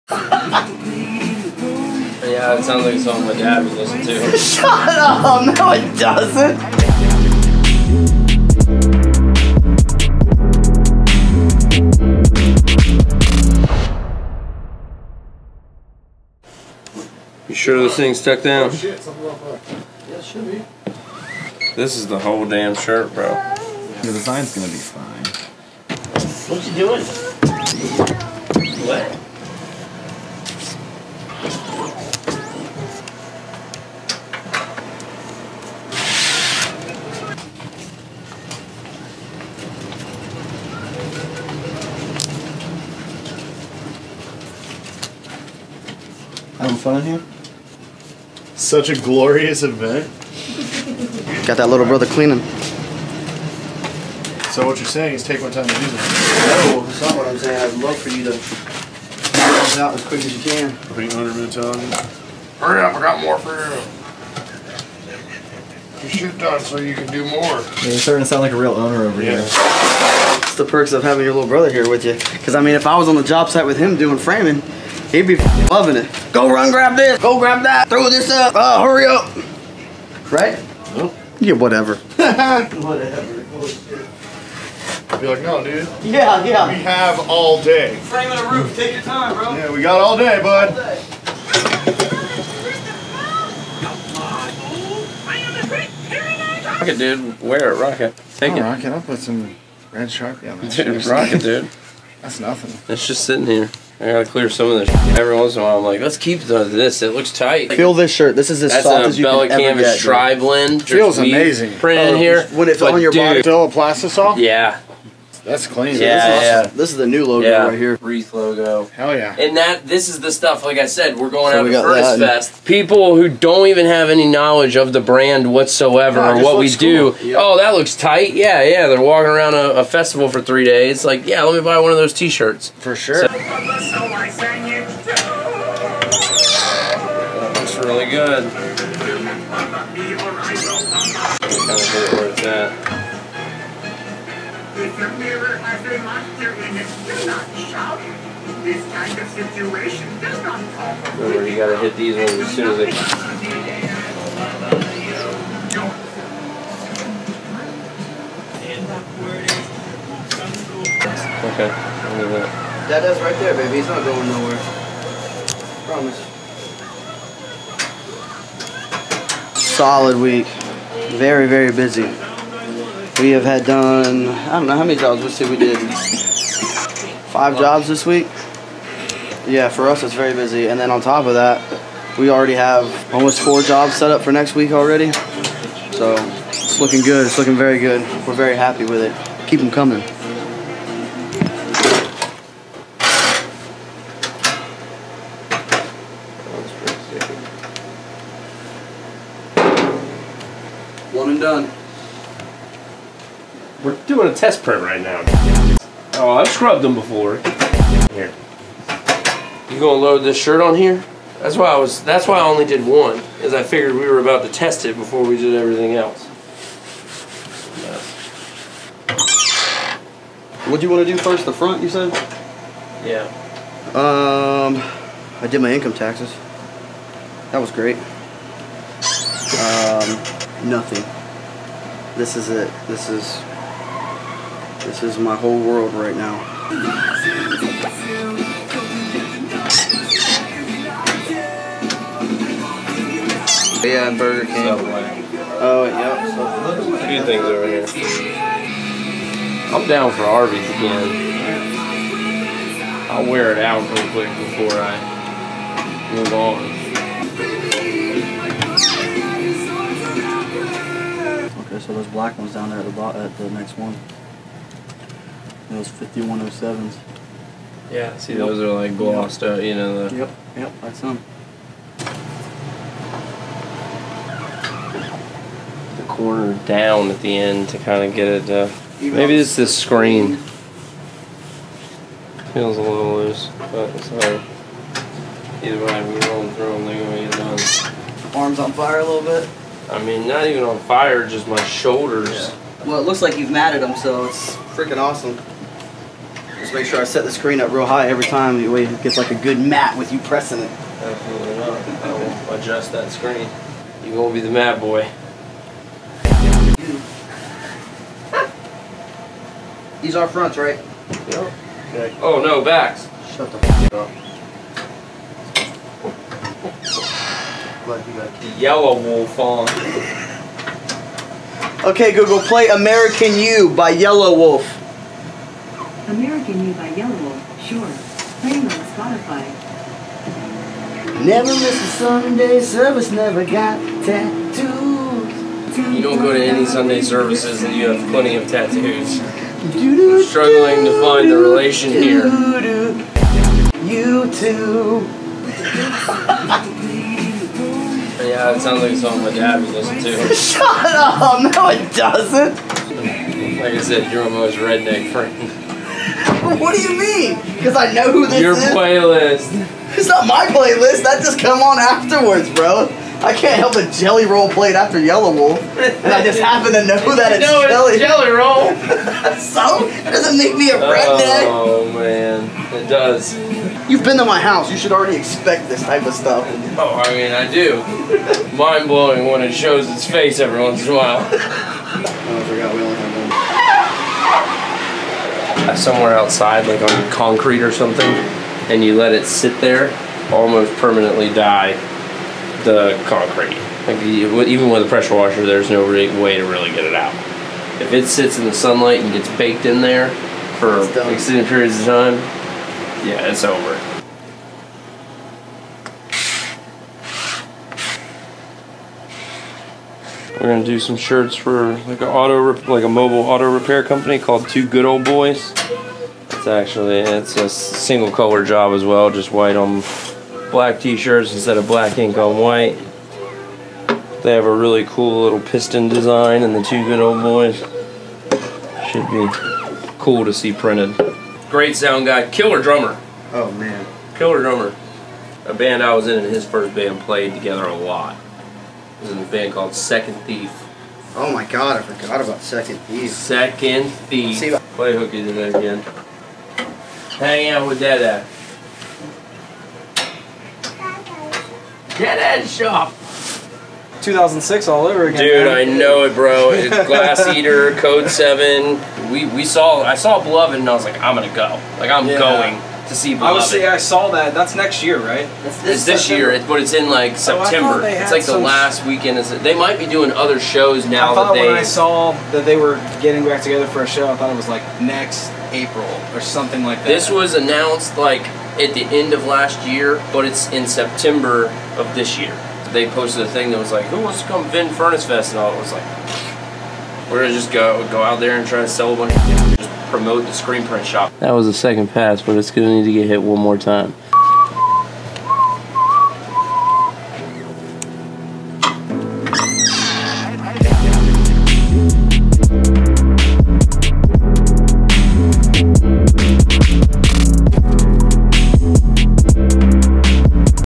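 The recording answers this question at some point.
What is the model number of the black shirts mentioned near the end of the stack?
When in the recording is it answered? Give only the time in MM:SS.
04:25.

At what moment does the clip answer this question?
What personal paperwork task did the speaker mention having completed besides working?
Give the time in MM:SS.
03:45.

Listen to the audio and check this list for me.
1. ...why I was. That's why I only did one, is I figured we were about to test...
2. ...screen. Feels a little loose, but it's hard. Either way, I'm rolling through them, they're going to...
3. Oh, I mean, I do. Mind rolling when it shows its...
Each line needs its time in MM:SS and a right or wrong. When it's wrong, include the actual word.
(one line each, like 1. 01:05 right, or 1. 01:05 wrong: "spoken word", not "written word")
1. 03:31 right
2. 04:39 right
3. 06:16 wrong: "blowing", not "rolling".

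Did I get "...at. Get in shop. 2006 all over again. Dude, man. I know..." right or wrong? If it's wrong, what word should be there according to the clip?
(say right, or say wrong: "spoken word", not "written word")
right.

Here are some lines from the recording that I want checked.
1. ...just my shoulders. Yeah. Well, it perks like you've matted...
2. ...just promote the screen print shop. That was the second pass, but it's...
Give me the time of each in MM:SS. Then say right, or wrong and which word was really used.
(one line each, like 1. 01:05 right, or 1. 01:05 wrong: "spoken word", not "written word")
1. 04:51 wrong: "looks", not "perks"
2. 08:09 right.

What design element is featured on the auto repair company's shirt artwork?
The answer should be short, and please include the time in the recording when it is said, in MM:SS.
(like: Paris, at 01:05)
piston, at 07:05.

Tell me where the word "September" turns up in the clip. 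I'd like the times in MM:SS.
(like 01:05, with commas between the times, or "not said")
07:47, 08:00.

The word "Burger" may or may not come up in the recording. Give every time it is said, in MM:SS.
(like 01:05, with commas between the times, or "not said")
04:04.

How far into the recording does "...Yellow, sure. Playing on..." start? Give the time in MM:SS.
05:26.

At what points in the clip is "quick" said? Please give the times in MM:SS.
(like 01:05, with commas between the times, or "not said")
01:00, 04:14.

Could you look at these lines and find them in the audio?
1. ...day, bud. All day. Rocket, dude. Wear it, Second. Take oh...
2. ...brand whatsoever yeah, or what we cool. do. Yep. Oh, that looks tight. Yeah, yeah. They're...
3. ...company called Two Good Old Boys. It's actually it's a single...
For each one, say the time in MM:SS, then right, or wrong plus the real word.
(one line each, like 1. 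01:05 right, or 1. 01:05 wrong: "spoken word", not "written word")
1. 01:30 wrong: "Rocket", not "Second"
2. 02:05 right
3. 06:53 right.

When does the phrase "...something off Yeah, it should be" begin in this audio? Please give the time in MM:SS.
00:18.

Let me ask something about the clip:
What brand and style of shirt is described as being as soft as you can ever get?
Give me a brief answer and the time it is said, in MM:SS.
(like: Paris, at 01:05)
Bella Canvas Tri Blend, at 01:49.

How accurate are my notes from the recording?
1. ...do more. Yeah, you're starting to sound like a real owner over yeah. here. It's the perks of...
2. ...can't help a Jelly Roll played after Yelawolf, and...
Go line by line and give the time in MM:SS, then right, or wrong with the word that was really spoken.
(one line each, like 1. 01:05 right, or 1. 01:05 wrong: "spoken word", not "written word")
1. 01:07 right
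2. 06:03 right.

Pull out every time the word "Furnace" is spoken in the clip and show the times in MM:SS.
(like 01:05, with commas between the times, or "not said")
02:01, 08:04.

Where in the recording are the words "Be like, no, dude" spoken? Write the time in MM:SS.
01:25.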